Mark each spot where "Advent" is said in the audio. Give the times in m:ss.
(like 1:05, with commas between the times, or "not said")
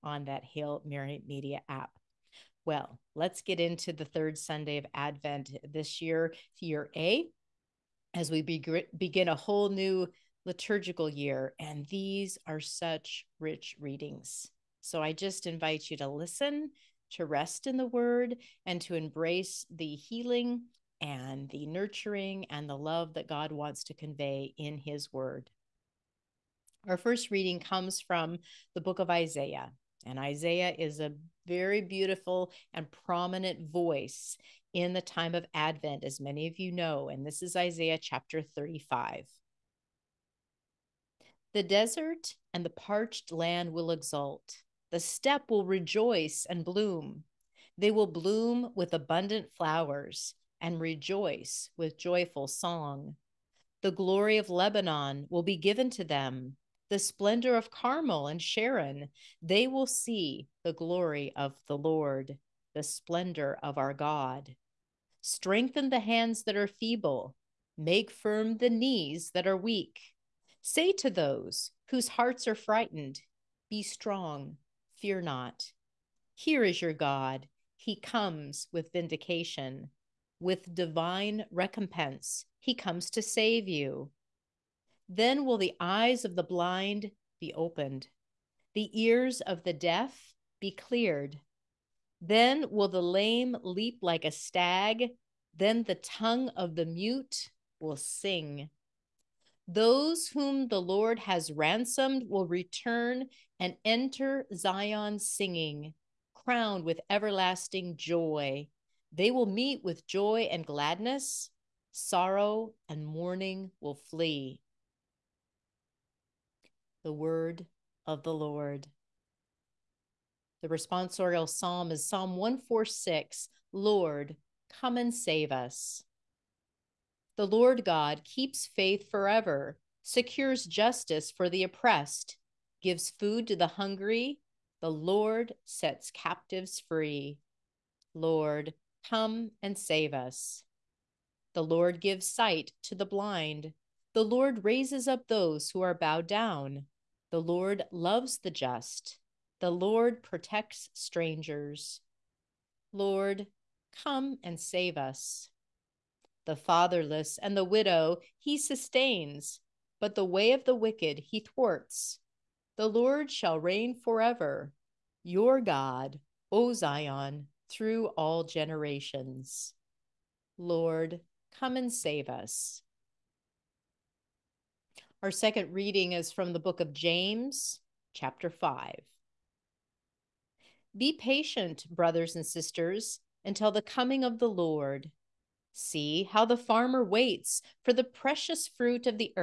0:04, 0:35.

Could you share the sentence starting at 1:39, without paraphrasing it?
Those whom the Lord has ransomed will return and enter Zion singing, crowned with everlasting joy.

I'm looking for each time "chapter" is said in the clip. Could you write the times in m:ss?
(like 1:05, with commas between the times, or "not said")
0:37, 2:58.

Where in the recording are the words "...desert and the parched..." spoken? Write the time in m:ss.
0:41.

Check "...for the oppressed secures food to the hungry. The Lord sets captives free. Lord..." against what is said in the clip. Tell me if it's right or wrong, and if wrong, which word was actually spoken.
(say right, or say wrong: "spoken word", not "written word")
wrong: "gives", not "secures".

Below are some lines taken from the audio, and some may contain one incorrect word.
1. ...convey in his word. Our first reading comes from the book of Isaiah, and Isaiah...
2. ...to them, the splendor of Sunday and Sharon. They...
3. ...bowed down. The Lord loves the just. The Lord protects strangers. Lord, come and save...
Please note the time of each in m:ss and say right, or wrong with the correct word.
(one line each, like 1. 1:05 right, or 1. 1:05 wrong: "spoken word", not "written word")
1. 0:23 right
2. 0:55 wrong: "Carmel", not "Sunday"
3. 2:25 right.